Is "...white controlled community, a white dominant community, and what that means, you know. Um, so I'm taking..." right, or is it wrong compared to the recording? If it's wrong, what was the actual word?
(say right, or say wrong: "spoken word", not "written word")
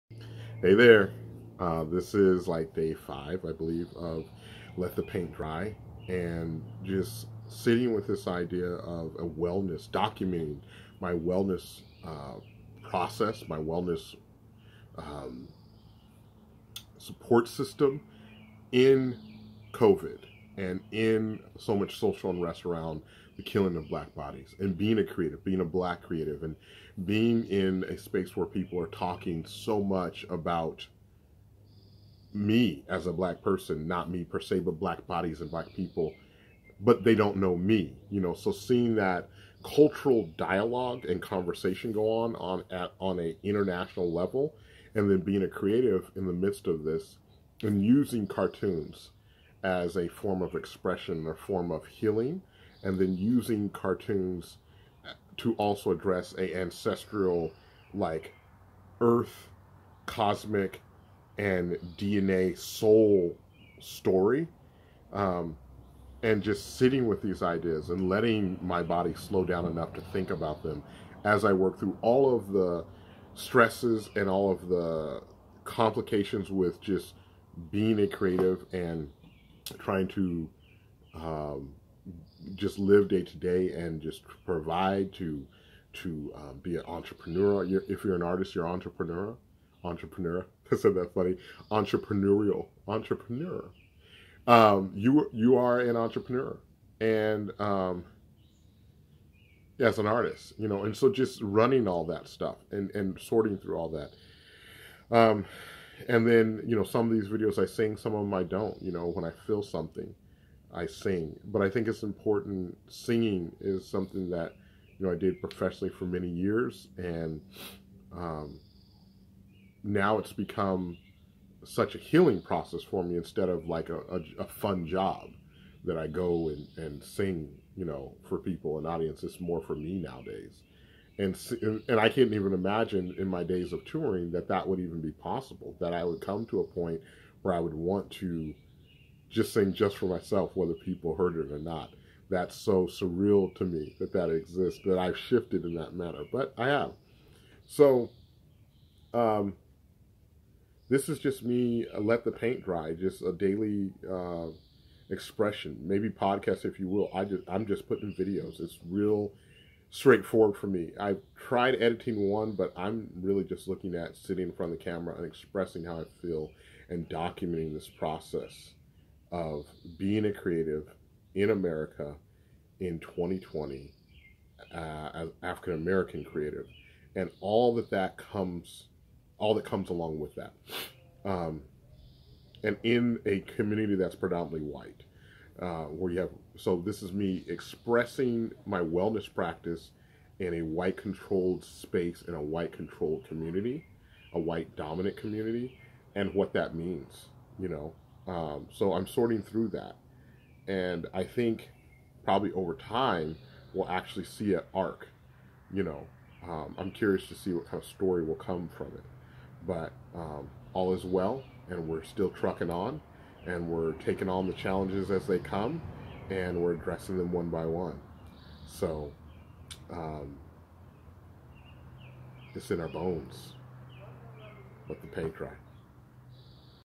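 wrong: "sorting", not "taking".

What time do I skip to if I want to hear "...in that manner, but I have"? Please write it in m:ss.
2:25.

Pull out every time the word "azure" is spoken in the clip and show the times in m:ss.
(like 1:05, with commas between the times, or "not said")
not said.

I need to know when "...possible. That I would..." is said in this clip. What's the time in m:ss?
2:15.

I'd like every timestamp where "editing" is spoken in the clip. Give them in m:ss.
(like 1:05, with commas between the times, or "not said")
2:41.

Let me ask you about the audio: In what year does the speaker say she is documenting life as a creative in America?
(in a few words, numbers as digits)
2020.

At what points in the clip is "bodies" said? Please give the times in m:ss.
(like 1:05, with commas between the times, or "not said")
0:24, 0:35.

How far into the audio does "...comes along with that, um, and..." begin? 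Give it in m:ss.
2:59.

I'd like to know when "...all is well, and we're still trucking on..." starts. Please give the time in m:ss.
3:30.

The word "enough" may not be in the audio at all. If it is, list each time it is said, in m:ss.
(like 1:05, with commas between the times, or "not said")
1:09.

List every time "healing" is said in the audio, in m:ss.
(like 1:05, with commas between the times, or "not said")
0:51, 2:01.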